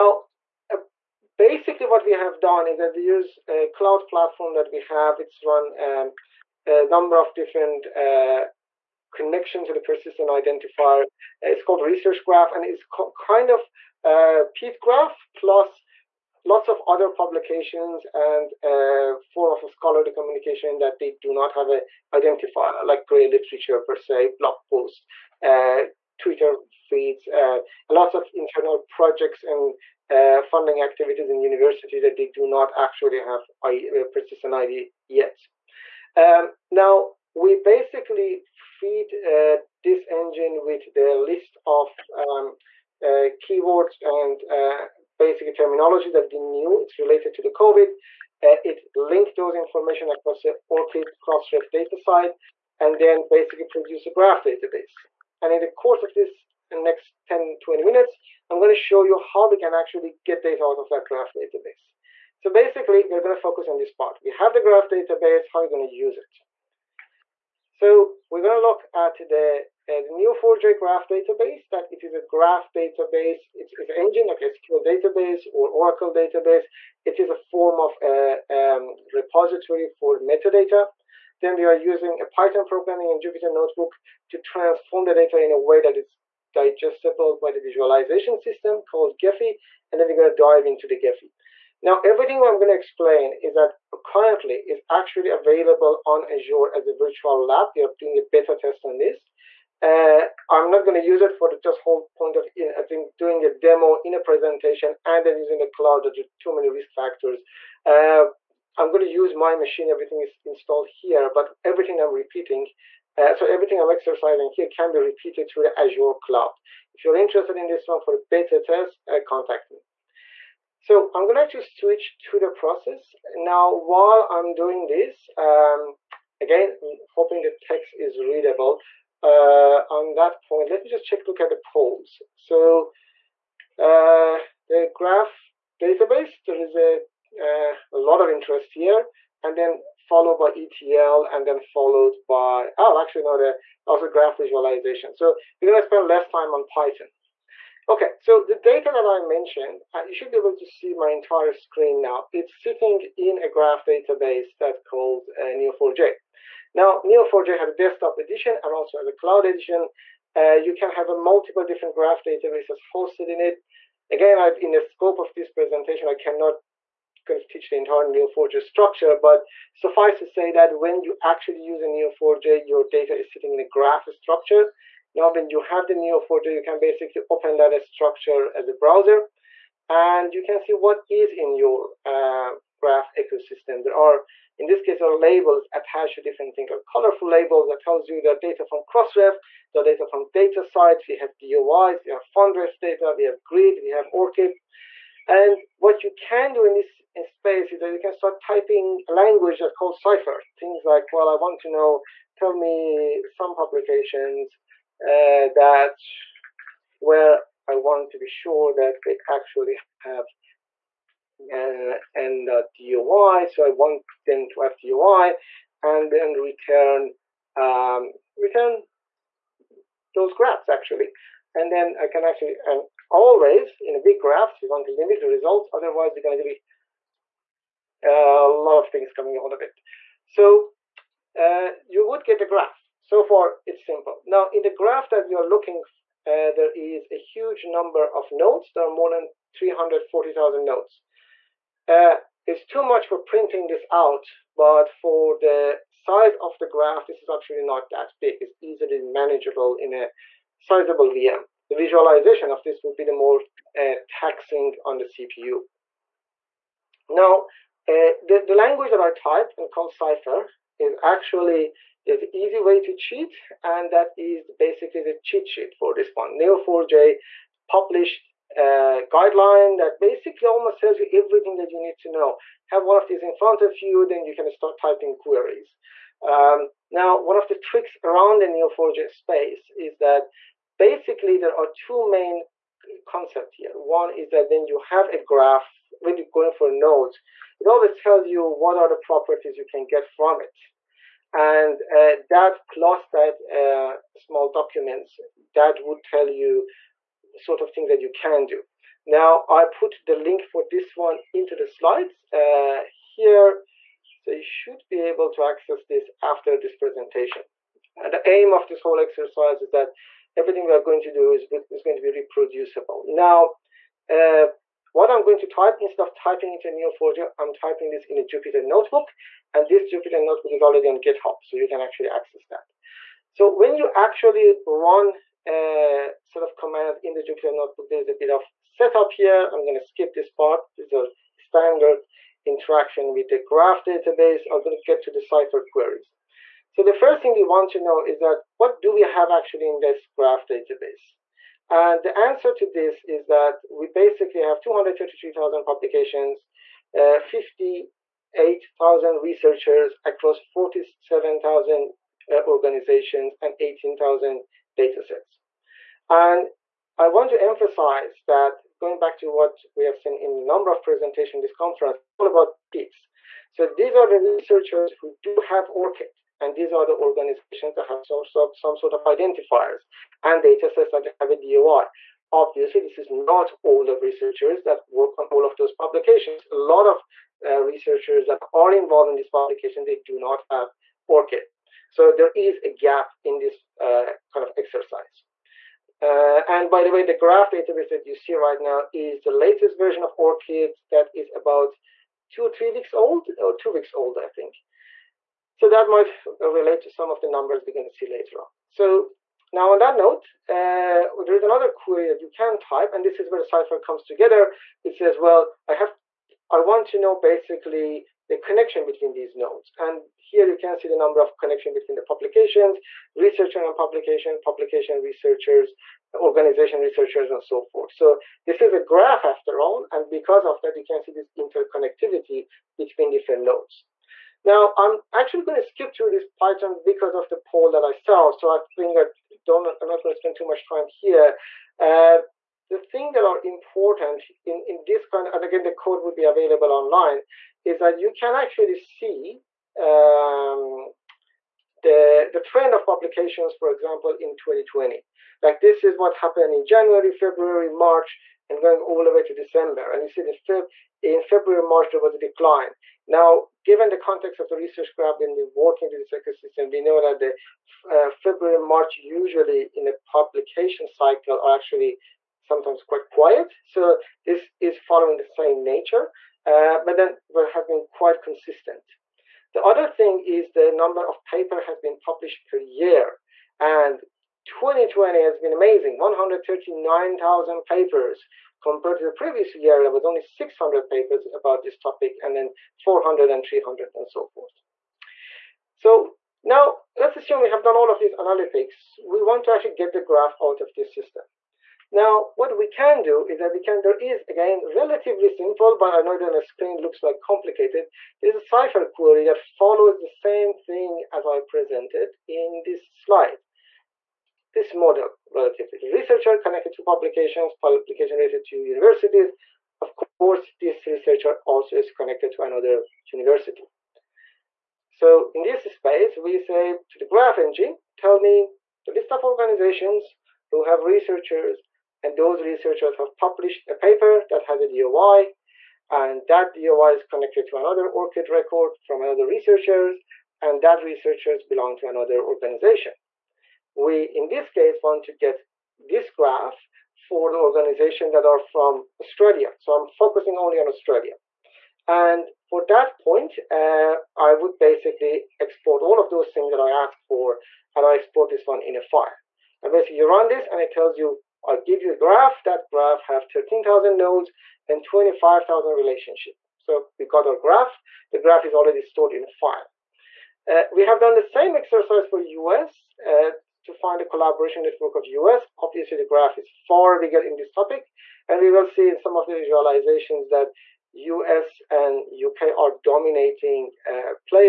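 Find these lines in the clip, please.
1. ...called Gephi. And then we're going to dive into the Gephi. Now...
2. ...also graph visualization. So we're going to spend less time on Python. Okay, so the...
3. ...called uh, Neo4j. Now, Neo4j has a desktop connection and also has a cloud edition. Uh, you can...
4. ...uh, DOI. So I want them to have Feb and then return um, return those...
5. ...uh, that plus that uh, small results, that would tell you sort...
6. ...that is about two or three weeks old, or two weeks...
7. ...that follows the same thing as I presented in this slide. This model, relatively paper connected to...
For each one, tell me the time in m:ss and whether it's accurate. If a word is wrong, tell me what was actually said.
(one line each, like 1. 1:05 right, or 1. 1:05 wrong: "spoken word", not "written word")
1. 1:28 right
2. 2:23 right
3. 2:34 wrong: "edition", not "connection"
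4. 3:32 wrong: "DOI", not "Feb"
5. 4:51 wrong: "documents", not "results"
6. 6:30 right
7. 8:19 wrong: "researcher", not "paper".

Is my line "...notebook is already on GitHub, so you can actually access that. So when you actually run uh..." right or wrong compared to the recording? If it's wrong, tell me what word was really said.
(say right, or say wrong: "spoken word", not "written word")
right.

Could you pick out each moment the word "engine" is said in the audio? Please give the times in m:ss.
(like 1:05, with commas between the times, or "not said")
0:40, 1:13, 8:37.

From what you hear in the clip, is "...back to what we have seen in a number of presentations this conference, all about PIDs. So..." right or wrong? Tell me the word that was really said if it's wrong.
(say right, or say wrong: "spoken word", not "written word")
right.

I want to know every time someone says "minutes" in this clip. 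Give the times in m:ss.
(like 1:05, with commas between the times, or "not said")
0:57.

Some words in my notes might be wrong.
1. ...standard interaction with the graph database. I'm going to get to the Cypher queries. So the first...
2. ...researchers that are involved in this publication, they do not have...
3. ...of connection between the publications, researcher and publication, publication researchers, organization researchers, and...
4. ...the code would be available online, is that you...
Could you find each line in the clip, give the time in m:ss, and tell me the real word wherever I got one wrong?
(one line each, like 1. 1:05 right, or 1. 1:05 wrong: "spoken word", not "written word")
1. 5:31 right
2. 6:17 right
3. 6:51 right
4. 7:15 right.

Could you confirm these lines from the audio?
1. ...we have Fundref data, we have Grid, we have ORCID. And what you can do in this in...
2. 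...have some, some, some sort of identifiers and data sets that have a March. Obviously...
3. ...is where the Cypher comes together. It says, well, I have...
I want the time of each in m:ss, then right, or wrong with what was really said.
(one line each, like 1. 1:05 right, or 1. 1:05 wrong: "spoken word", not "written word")
1. 3:12 right
2. 6:07 wrong: "DOI", not "March"
3. 6:43 right.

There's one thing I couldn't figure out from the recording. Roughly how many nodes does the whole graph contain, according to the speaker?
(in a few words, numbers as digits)
340,000.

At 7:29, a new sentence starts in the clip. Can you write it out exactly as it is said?
And you see in, Feb in February, March, there was a decline.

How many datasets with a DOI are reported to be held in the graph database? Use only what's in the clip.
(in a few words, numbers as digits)
18,000.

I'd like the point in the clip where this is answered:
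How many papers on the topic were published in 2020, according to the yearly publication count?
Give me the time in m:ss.
7:55.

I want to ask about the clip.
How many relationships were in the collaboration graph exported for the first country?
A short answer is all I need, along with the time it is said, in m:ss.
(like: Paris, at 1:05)
25,000, at 9:14.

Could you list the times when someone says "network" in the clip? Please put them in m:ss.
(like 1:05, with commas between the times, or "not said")
9:24.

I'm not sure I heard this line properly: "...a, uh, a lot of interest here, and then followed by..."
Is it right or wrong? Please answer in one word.
right.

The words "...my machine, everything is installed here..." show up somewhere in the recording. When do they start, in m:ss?
1:49.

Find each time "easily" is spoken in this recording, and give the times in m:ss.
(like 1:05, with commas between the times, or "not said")
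4:08.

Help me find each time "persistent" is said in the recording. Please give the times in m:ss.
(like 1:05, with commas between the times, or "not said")
0:09, 0:34.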